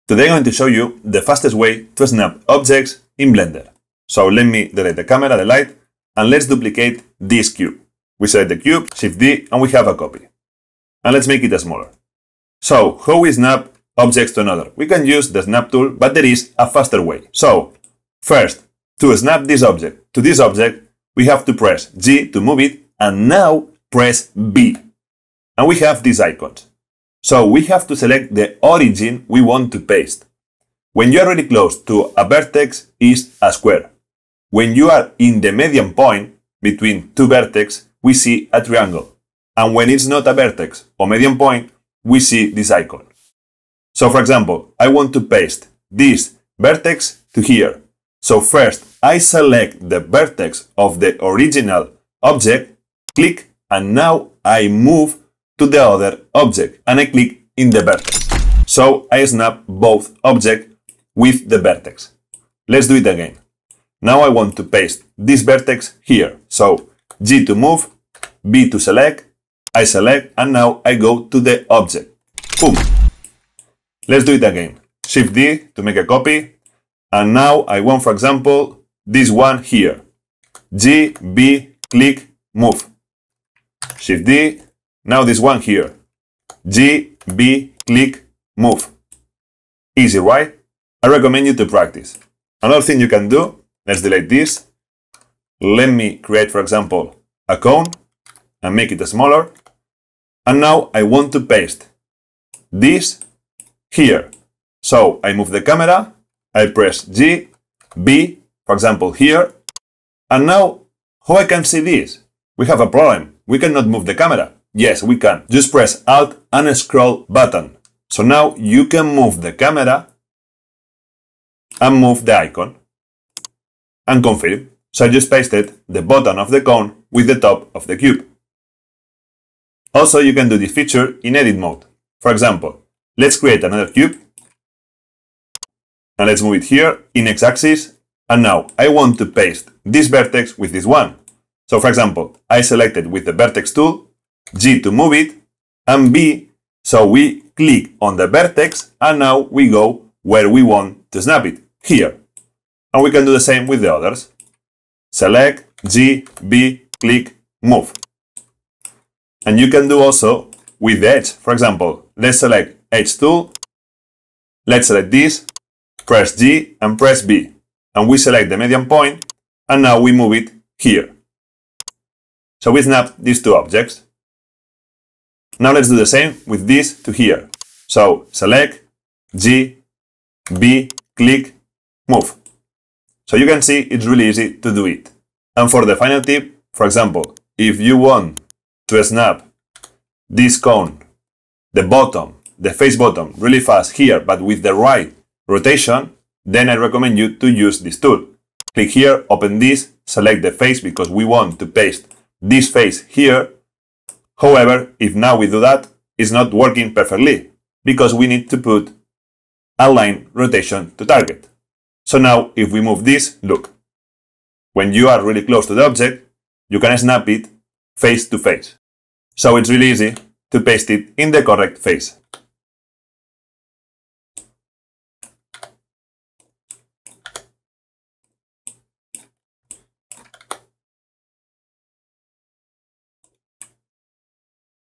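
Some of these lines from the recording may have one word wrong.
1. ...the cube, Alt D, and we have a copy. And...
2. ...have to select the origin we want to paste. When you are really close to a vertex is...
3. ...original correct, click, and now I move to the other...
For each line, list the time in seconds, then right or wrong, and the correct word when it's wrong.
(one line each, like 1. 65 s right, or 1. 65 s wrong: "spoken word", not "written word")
1. 8 s wrong: "Shift", not "Alt"
2. 27 s right
3. 51 s wrong: "object", not "correct".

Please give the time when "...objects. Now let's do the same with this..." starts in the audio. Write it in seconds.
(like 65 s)
173 s.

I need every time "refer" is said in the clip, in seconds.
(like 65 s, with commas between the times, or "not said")
not said.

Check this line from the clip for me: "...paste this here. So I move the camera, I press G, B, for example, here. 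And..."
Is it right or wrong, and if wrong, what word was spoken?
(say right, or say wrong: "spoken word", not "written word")
right.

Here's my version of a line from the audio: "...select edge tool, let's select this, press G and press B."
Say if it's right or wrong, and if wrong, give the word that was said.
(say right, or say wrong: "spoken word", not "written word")
right.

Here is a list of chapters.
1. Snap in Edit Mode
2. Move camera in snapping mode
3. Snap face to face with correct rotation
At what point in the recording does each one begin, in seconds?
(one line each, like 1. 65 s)
1. 129 s
2. 100 s
3. 185 s.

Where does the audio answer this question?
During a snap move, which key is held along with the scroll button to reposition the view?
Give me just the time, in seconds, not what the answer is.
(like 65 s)
116 s.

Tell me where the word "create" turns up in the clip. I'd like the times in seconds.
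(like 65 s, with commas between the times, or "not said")
96 s, 133 s.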